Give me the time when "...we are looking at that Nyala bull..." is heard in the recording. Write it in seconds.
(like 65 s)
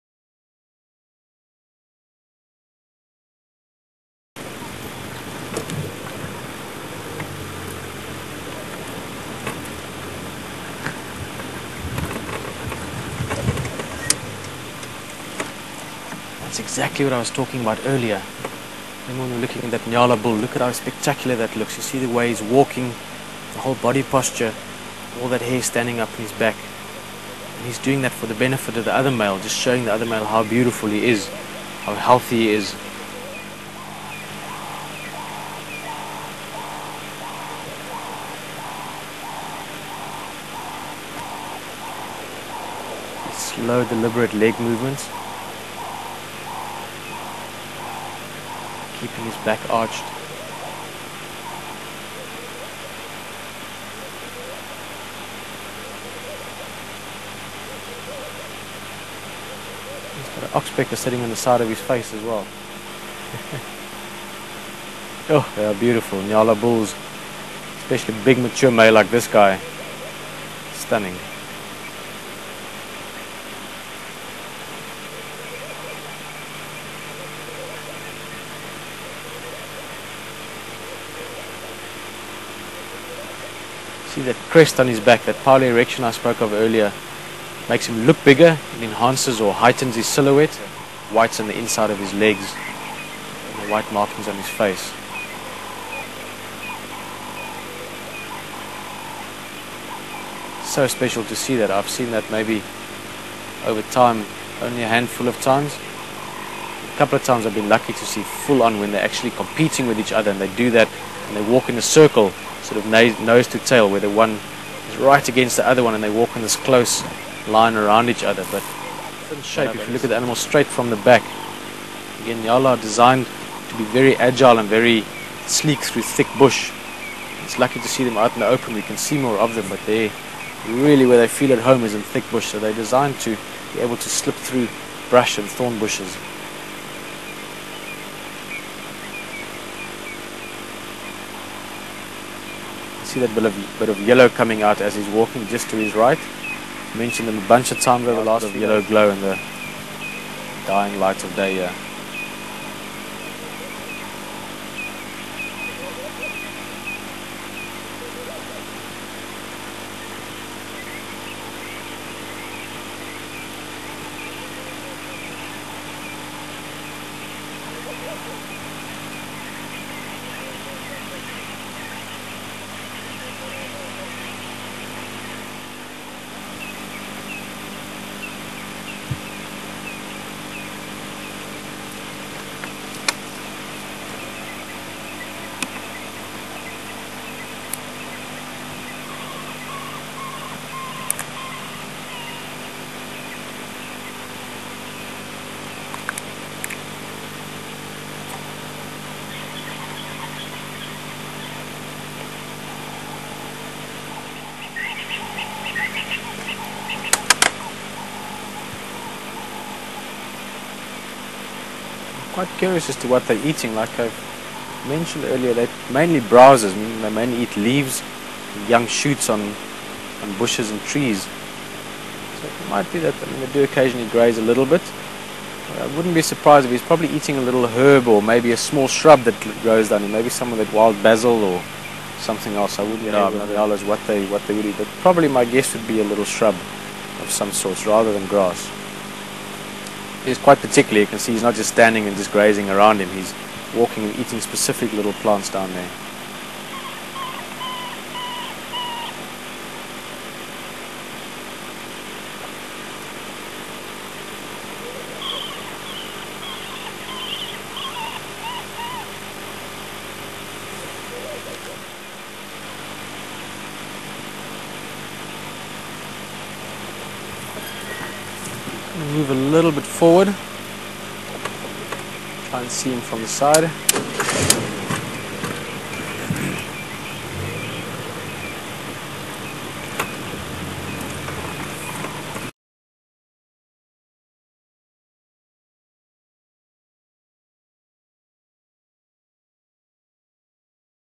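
19 s.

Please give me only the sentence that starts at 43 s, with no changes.
slow deliberate leg movements keeping his back arched.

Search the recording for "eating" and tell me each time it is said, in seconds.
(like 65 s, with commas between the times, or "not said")
213 s, 227 s, 244 s.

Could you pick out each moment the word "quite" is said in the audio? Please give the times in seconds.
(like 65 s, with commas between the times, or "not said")
212 s, 240 s.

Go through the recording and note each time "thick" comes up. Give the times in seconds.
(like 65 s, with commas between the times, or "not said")
126 s, 132 s.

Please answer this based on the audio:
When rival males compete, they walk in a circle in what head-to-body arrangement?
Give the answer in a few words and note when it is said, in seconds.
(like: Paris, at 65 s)
nose to tail, at 112 s.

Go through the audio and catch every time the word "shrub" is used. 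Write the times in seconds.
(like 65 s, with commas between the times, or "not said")
228 s, 236 s.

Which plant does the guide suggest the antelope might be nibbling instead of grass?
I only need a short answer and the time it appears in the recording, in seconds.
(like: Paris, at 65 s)
wild basil, at 230 s.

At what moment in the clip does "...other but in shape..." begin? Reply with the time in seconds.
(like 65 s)
118 s.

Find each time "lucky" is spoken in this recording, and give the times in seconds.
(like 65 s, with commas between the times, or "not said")
107 s, 127 s.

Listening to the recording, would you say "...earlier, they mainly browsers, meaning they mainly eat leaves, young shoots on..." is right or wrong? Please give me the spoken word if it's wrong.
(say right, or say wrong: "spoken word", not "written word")
right.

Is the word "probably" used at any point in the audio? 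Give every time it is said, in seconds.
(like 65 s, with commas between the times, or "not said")
226 s, 235 s.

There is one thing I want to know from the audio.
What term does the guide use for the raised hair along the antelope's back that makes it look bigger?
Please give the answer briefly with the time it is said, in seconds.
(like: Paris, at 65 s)
pilo-erection, at 85 s.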